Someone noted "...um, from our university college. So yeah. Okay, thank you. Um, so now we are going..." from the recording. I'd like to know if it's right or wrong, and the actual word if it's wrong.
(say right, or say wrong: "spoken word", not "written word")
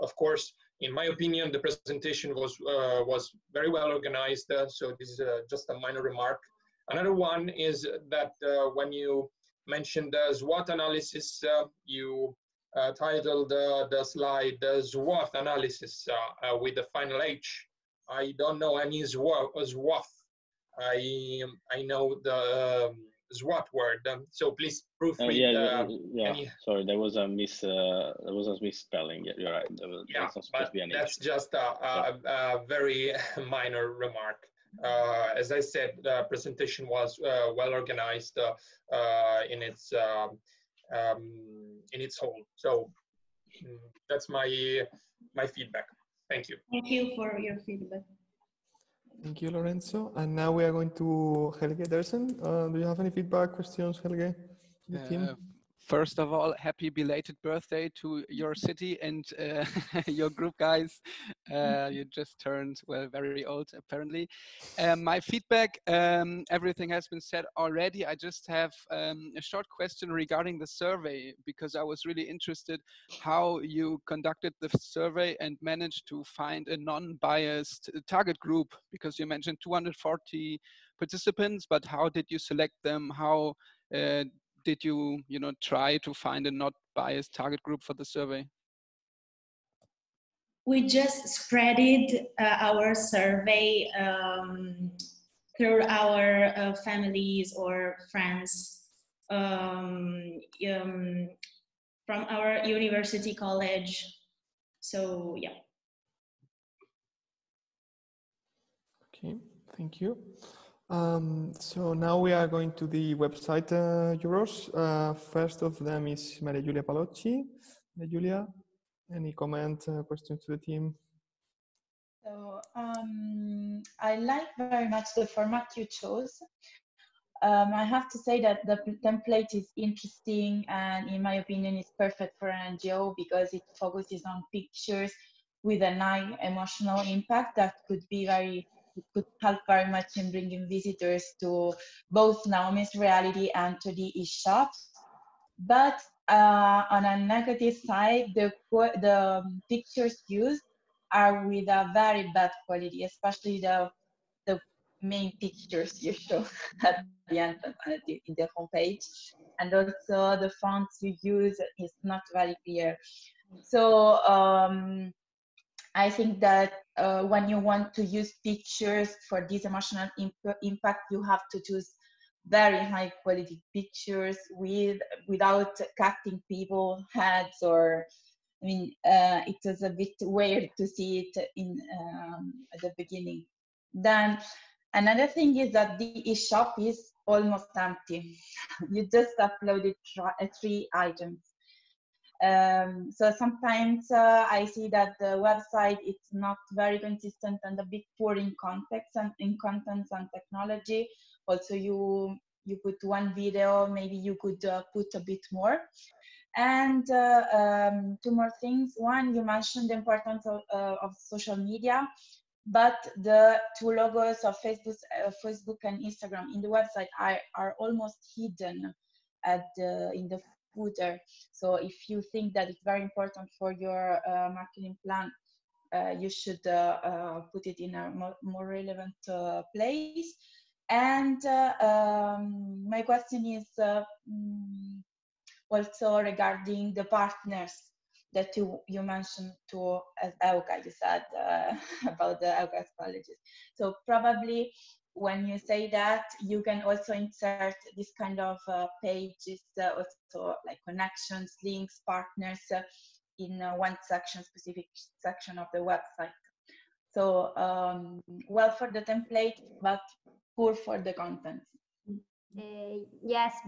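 right.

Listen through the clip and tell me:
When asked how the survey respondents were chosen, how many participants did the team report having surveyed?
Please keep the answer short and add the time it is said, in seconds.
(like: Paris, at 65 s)
240, at 79 s.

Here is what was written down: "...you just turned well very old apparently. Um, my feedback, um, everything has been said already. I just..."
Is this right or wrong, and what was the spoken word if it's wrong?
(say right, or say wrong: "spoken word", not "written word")
right.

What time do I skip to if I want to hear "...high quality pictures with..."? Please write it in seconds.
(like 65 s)
172 s.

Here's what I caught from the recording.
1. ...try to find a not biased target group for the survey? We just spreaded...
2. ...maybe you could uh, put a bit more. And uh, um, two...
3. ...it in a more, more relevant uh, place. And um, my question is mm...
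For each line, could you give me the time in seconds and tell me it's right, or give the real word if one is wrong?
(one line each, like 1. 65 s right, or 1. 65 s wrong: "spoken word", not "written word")
1. 85 s right
2. 203 s right
3. 227 s right.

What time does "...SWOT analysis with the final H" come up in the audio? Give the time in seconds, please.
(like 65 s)
14 s.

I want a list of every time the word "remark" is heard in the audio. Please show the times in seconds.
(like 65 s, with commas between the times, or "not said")
6 s, 33 s.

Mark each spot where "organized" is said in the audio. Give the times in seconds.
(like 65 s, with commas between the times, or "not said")
3 s, 37 s.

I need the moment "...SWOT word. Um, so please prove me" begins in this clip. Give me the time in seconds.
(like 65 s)
23 s.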